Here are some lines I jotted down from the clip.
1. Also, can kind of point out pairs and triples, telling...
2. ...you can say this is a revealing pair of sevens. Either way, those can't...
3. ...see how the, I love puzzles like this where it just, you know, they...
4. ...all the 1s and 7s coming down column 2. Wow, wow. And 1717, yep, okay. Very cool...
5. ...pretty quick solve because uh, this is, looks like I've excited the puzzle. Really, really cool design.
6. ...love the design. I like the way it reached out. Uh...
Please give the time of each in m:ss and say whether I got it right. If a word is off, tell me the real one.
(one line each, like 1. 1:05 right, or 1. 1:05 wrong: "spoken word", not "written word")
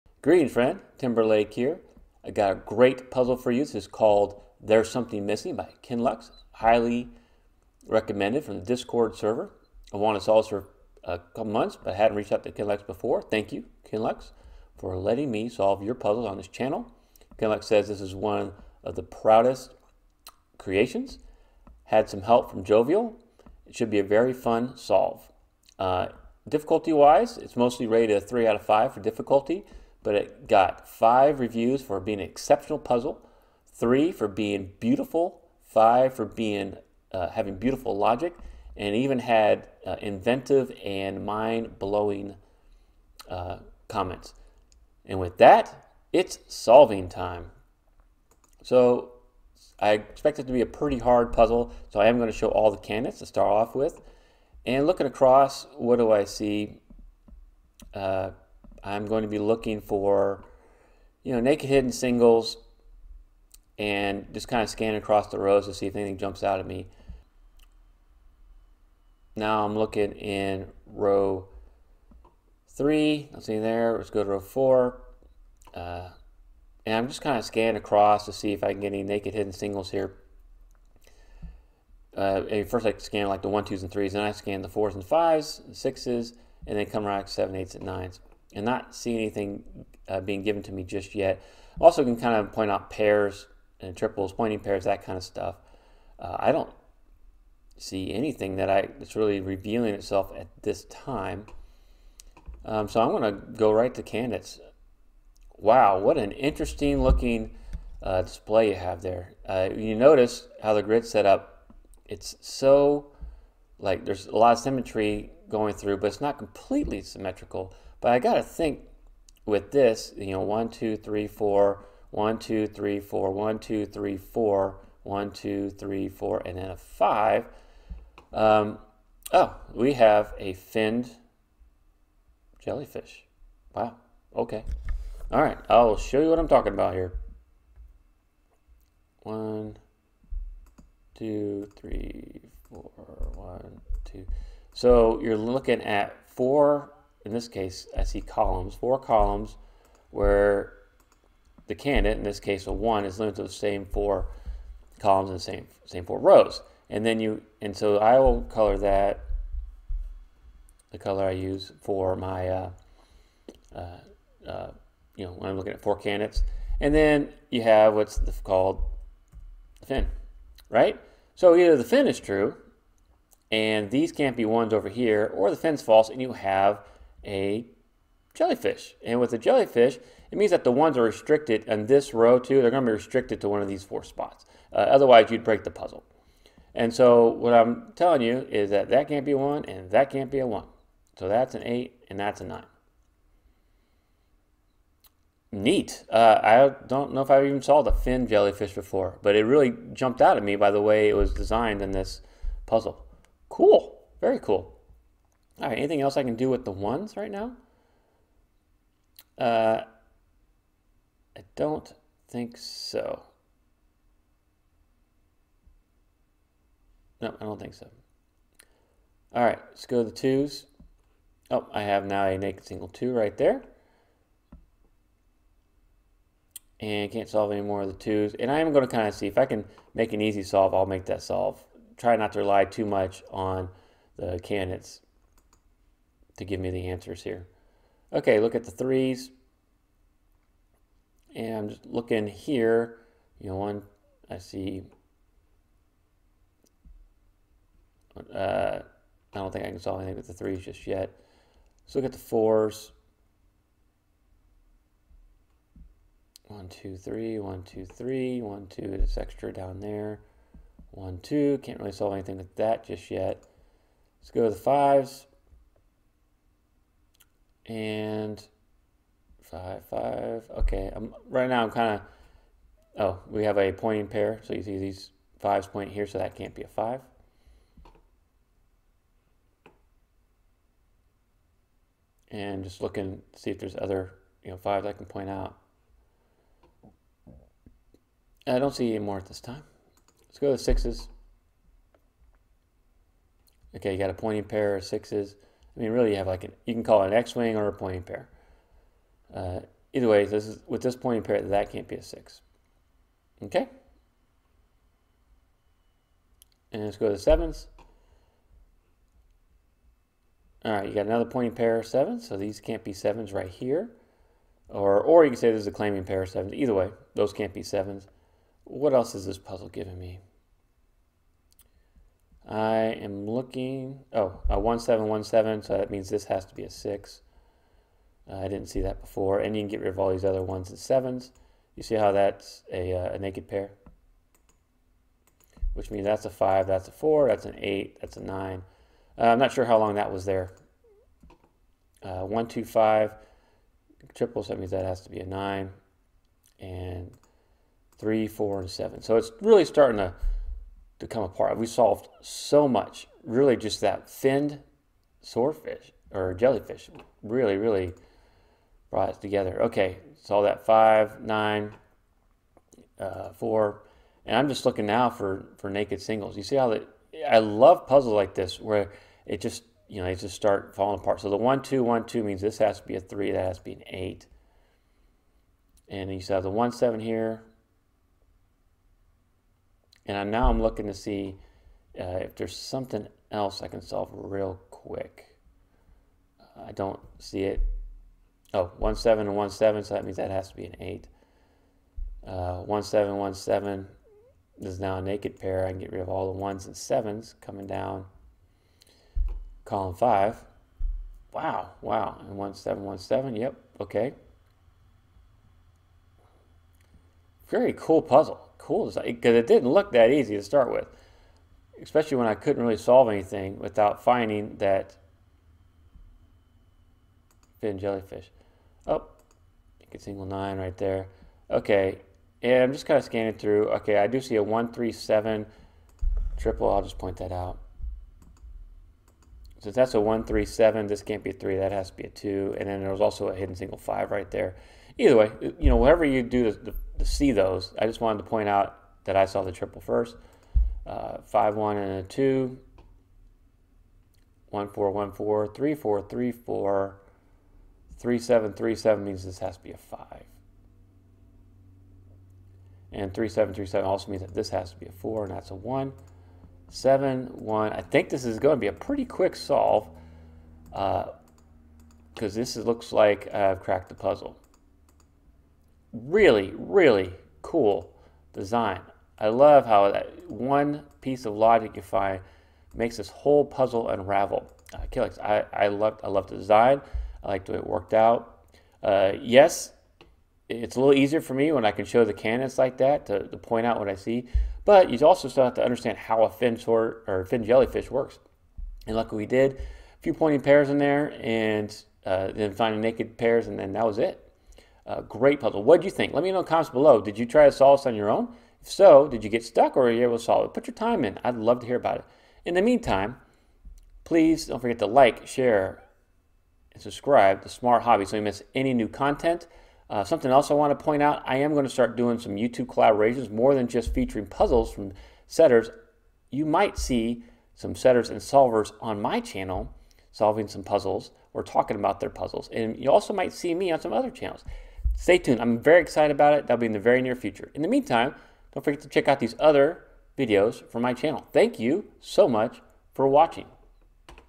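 1. 1:31 wrong: "pointing", not "telling"
2. 5:15 wrong: "claiming", not "revealing"
3. 6:06 right
4. 6:36 wrong: "5", not "2"
5. 7:38 wrong: "cracked", not "excited"
6. 7:56 wrong: "worked", not "reached".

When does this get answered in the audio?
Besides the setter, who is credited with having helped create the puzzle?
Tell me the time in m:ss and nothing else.
0:22.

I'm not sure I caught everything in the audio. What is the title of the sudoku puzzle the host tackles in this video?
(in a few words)
There's Something Missing.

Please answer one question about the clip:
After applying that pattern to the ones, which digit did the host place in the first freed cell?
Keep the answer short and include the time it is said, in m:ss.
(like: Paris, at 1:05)
8, at 3:11.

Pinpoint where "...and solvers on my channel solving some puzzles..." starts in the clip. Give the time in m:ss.
8:38.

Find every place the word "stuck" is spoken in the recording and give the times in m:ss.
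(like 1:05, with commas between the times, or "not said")
8:19.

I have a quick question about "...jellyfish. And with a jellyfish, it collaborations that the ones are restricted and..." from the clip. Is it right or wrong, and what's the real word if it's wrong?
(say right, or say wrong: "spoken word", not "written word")
wrong: "means", not "collaborations".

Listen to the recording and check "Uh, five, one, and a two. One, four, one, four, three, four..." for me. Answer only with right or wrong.
right.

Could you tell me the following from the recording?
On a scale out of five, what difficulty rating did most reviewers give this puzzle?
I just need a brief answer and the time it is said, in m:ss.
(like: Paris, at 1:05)
3, at 0:28.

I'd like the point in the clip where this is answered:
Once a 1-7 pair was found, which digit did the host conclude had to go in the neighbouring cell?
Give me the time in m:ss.
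5:26.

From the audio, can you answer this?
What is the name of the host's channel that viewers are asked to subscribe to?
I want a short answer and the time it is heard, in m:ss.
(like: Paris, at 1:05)
Smart Hobby, at 8:27.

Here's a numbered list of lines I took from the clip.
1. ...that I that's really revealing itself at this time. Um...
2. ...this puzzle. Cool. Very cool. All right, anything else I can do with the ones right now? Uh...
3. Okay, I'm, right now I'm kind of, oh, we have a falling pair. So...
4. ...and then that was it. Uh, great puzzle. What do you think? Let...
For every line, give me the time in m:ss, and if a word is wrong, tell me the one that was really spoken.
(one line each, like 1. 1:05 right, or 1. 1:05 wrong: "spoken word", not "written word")
1. 1:38 right
2. 3:21 right
3. 4:30 wrong: "pointing", not "falling"
4. 8:13 right.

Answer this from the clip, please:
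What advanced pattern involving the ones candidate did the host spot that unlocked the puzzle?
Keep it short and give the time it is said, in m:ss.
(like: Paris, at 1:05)
Finned jellyfish, at 2:10.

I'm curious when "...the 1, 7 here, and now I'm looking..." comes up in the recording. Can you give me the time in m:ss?
6:16.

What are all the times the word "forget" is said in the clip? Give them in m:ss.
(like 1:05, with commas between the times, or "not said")
8:24, 8:48.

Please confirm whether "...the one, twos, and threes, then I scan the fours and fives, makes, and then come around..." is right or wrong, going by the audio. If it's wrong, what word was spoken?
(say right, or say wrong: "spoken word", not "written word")
wrong: "sixes", not "makes".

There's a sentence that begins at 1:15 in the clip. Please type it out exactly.
Uh, and I'm just kind of scanning across to see if I can get any naked hidden singles here.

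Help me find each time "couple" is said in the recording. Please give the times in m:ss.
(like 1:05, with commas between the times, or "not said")
0:11.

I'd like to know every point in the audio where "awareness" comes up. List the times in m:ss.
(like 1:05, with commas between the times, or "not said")
not said.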